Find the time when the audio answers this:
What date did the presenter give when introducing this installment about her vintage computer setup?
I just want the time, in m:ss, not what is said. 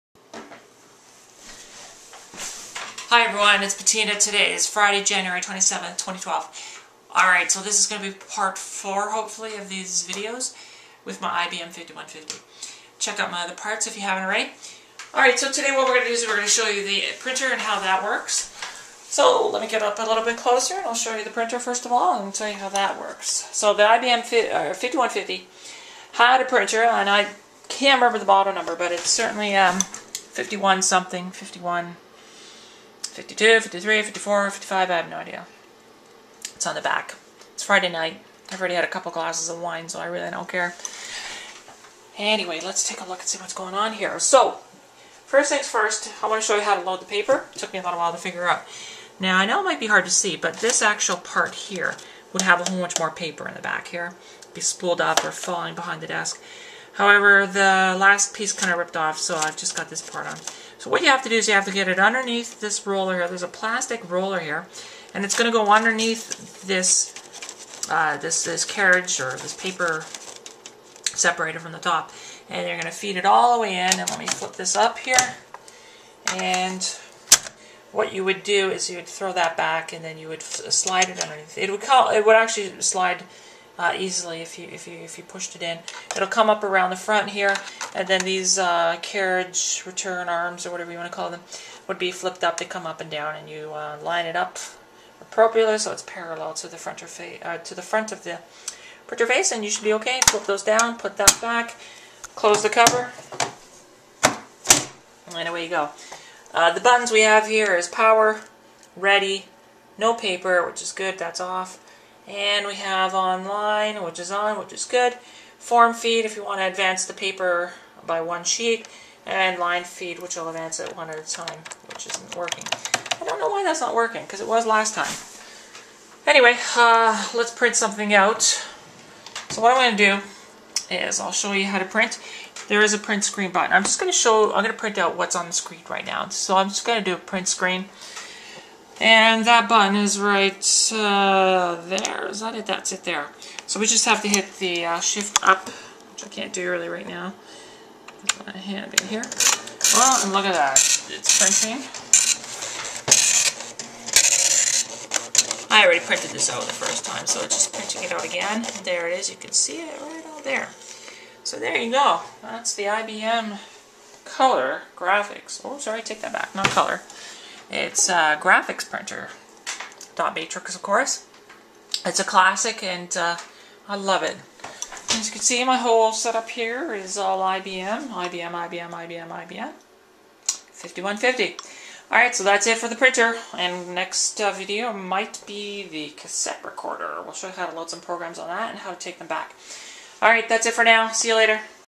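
0:04.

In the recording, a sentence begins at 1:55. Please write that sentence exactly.
Form feed, if you want to advance the paper by one sheet.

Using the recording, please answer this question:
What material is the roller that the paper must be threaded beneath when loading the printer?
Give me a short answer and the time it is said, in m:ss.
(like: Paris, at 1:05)
Plastic, at 1:03.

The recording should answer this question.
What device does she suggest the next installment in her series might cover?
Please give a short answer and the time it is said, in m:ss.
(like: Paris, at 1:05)
The cassette recorder, at 3:05.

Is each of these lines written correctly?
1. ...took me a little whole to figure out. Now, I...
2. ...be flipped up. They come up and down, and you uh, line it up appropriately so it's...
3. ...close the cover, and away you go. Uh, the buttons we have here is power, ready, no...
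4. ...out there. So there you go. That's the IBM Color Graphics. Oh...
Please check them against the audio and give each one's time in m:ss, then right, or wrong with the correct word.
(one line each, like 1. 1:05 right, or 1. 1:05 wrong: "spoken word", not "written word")
1. 0:47 wrong: "while", not "whole"
2. 1:31 right
3. 1:42 right
4. 2:40 right.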